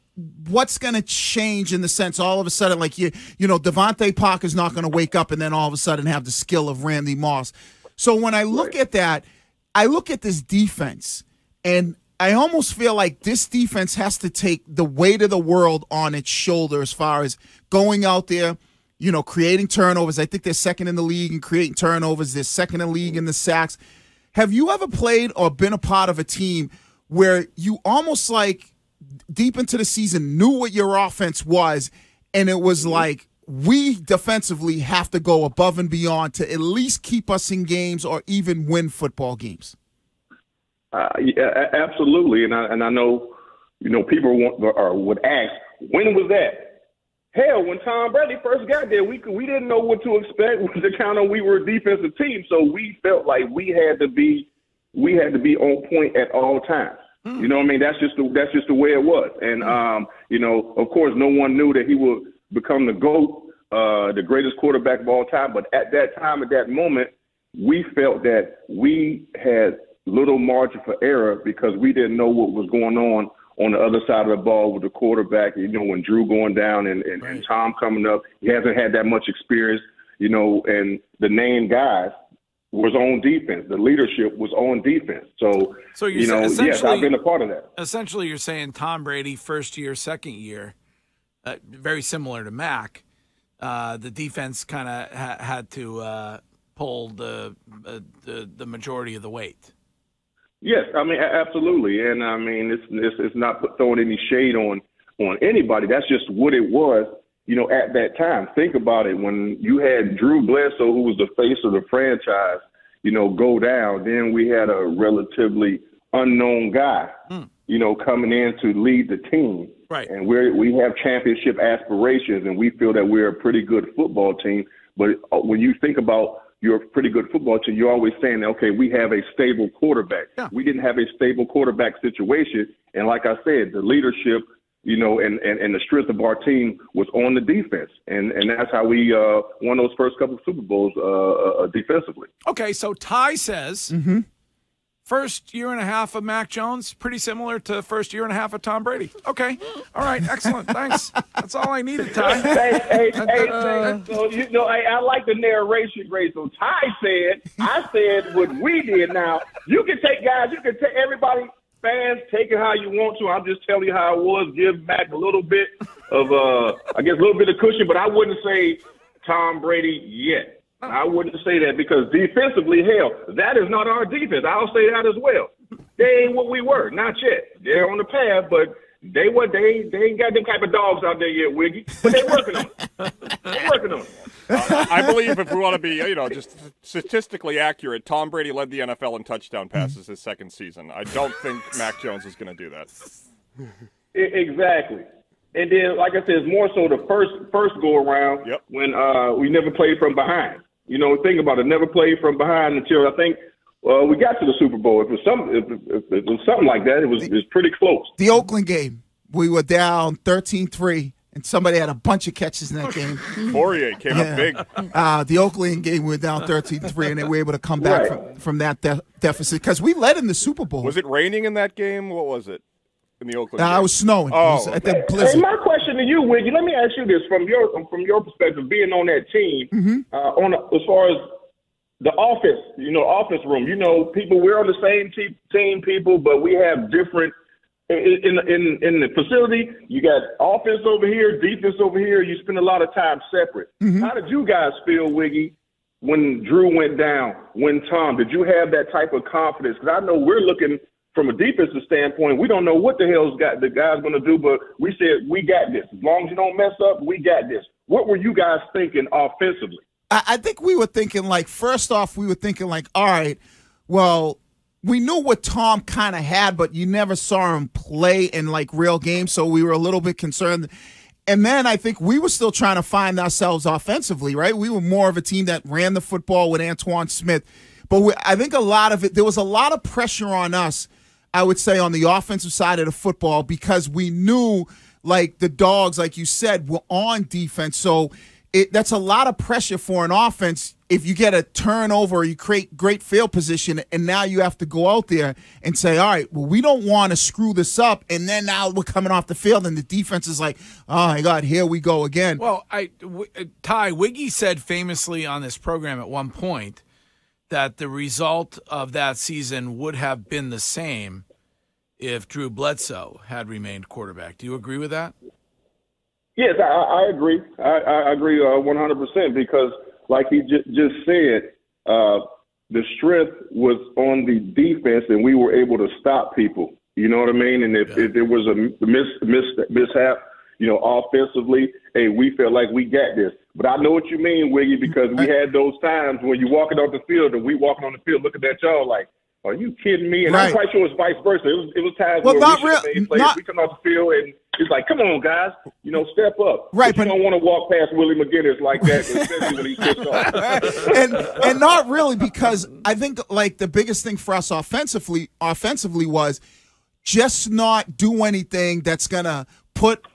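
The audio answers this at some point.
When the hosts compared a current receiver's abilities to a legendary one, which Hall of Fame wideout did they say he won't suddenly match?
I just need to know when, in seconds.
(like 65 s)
6 s.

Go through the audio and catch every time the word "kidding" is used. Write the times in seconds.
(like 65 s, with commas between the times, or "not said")
339 s.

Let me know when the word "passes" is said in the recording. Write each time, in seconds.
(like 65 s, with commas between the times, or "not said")
189 s.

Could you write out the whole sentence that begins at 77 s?
and Tom coming up, he hasn't had that much experience.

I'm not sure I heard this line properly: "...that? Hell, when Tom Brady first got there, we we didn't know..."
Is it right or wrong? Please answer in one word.
right.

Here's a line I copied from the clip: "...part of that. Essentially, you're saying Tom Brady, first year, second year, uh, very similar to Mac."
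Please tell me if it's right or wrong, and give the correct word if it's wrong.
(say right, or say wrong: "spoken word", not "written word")
right.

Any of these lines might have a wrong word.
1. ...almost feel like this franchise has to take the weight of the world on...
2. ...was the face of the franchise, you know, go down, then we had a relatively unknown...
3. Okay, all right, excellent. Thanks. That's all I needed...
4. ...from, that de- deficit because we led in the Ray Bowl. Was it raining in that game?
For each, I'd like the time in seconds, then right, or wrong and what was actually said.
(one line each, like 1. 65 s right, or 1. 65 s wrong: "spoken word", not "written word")
1. 12 s wrong: "defense", not "franchise"
2. 111 s right
3. 149 s right
4. 218 s wrong: "Super", not "Ray".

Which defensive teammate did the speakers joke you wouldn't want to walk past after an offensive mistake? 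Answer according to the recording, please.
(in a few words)
Willie McGinest.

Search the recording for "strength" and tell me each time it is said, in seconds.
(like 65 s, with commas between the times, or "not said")
135 s, 322 s.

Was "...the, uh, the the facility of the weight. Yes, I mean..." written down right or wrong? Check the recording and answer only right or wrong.
wrong.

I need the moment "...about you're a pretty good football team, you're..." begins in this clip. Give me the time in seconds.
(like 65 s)
125 s.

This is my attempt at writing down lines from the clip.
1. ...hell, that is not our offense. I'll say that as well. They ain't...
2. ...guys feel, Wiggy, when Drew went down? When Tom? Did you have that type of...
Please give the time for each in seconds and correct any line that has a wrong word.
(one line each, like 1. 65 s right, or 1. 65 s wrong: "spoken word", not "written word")
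1. 172 s wrong: "defense", not "offense"
2. 244 s right.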